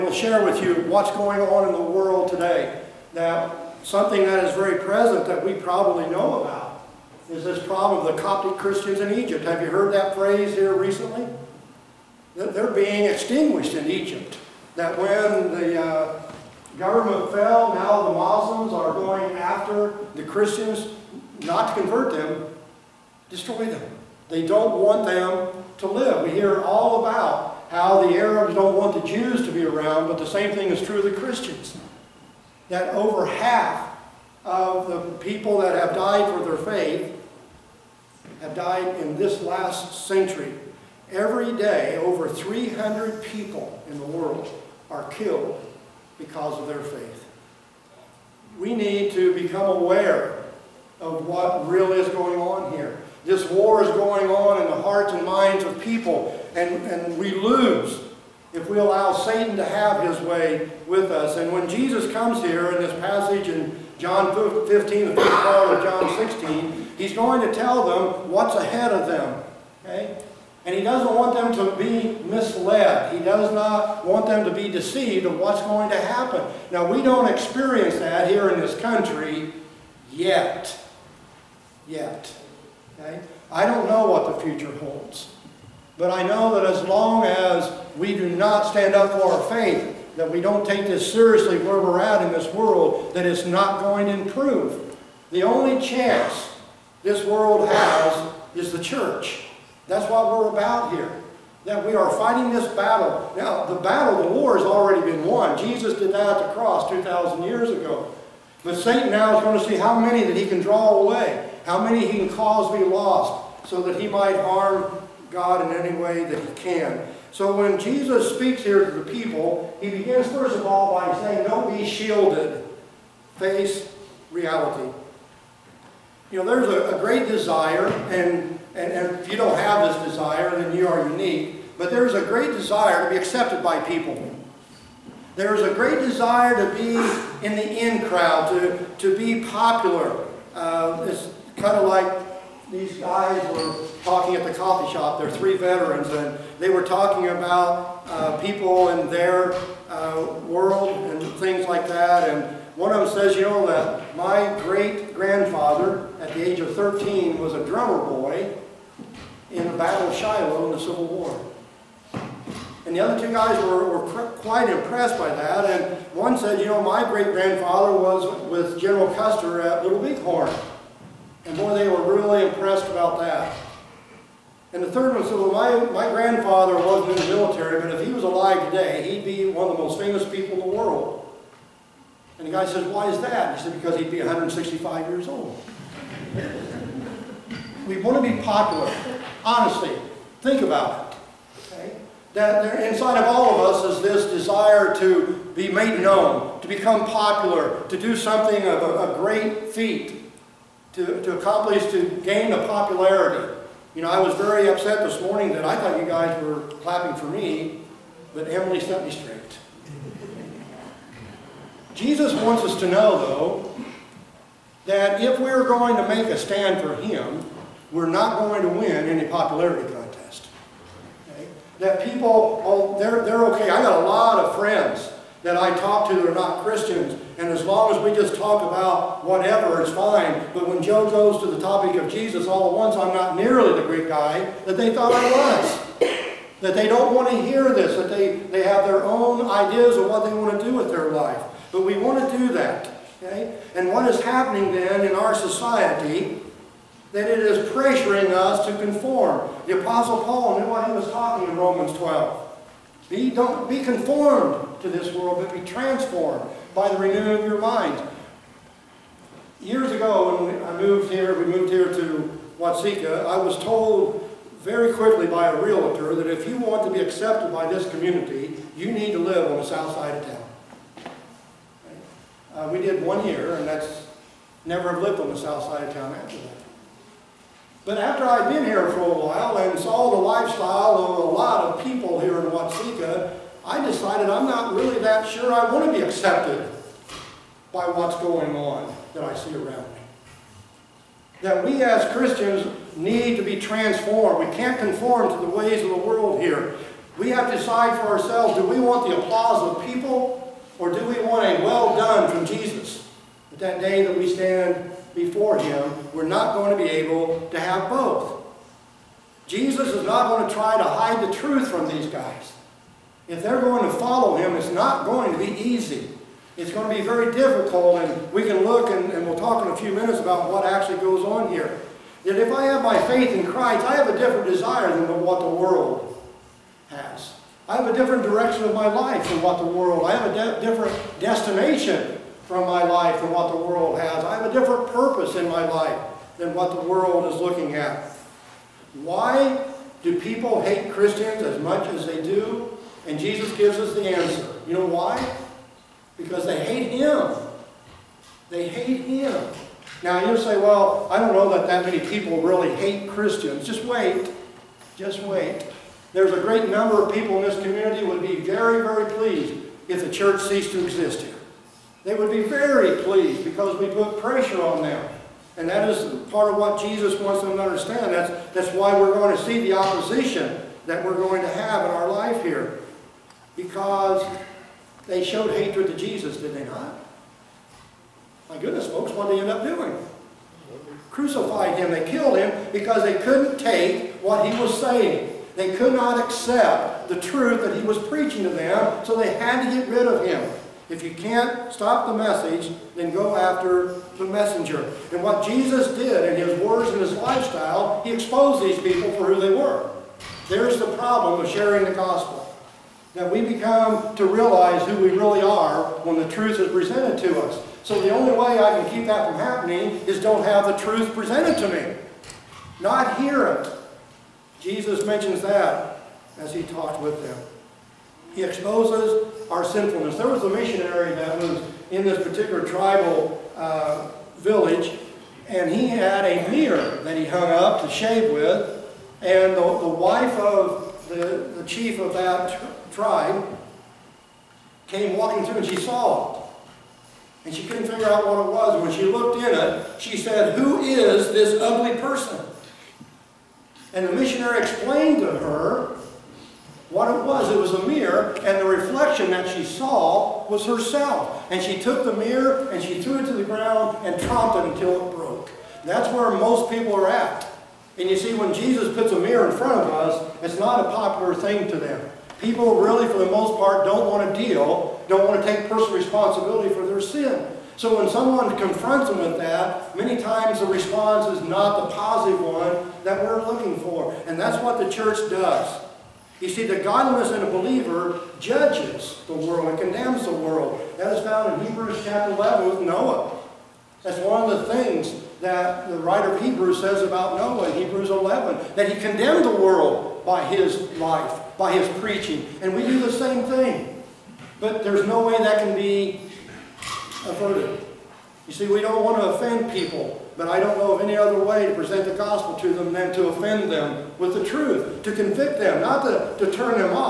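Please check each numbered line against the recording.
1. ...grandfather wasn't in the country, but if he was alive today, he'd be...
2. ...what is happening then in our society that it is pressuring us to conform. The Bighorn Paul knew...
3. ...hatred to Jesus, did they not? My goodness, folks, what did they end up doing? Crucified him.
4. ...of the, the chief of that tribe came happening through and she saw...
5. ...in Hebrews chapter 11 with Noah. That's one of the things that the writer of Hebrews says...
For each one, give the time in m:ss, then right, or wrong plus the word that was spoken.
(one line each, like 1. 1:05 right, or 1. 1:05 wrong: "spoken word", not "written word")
1. 2:56 wrong: "military", not "country"
2. 4:03 wrong: "Apostle", not "Bighorn"
3. 6:15 right
4. 7:10 wrong: "walking", not "happening"
5. 8:01 right.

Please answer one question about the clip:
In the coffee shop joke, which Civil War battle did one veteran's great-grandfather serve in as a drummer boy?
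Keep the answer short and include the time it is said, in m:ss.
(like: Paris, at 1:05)
Battle of Shiloh, at 2:39.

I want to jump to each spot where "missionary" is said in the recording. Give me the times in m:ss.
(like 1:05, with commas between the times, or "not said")
7:00, 7:24.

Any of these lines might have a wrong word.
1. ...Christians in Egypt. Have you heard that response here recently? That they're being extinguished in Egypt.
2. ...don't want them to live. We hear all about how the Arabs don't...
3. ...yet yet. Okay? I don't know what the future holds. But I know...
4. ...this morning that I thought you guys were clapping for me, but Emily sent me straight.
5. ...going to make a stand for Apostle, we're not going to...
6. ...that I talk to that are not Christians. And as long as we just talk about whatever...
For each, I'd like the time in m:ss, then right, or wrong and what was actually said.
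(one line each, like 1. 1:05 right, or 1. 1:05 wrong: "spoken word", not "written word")
1. 0:08 wrong: "phrase", not "response"
2. 0:24 right
3. 1:20 right
4. 3:25 right
5. 3:35 wrong: "Him", not "Apostle"
6. 3:45 right.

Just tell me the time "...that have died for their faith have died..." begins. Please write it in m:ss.
0:35.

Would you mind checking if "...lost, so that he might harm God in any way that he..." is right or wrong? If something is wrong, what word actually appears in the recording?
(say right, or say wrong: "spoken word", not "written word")
right.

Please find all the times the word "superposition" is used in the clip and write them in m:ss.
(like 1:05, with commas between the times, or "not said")
not said.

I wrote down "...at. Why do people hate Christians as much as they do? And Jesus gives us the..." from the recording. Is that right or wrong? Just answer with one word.
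right.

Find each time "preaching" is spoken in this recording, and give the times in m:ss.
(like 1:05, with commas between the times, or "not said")
6:27, 8:12.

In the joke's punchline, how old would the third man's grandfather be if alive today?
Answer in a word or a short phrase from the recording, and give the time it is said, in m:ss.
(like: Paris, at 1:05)
165, at 3:04.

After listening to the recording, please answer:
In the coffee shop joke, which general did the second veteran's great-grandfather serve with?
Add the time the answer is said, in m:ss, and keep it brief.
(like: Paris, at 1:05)
General Custer, at 2:48.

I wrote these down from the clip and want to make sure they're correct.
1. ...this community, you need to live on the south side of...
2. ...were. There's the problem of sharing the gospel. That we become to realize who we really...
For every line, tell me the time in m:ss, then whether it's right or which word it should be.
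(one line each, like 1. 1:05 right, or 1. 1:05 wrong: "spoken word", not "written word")
1. 4:27 right
2. 6:39 right.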